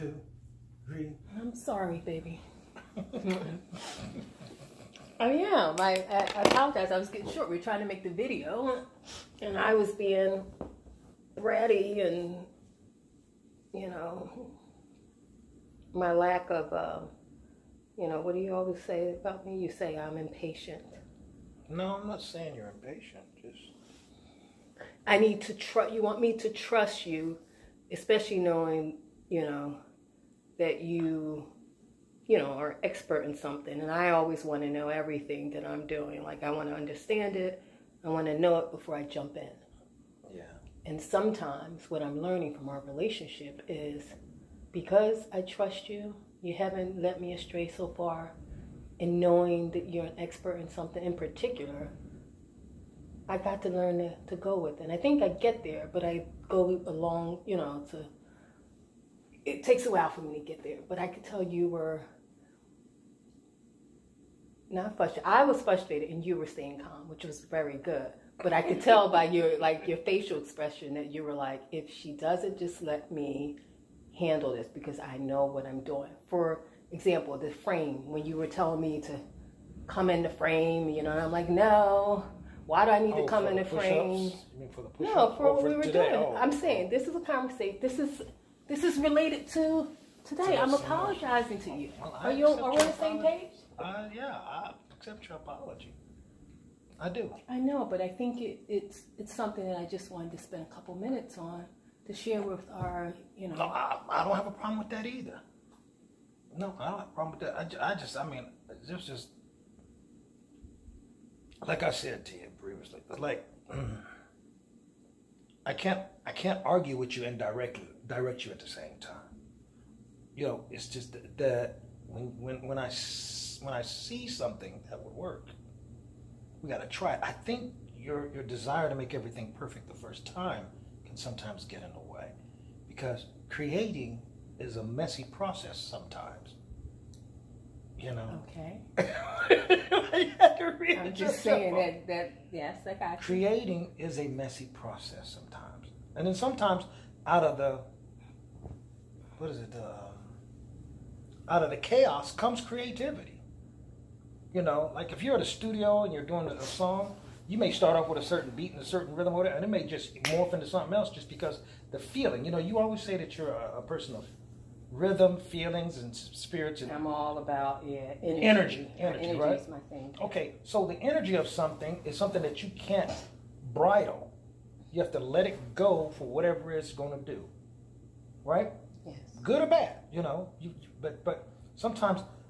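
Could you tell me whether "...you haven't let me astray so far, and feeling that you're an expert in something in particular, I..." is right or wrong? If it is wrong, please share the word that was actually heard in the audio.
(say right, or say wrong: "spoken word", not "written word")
wrong: "knowing", not "feeling".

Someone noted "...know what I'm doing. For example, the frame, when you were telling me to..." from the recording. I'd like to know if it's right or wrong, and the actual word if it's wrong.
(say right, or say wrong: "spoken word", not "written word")
right.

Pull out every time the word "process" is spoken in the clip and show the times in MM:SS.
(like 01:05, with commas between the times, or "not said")
02:15, 02:24.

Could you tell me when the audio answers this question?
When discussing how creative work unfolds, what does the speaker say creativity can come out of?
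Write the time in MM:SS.
02:31.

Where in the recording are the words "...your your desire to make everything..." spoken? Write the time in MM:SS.
02:07.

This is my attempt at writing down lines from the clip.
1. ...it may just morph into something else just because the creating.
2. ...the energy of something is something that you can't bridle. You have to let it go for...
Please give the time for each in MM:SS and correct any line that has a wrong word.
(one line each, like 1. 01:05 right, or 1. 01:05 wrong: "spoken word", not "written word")
1. 02:39 wrong: "feeling", not "creating"
2. 02:50 right.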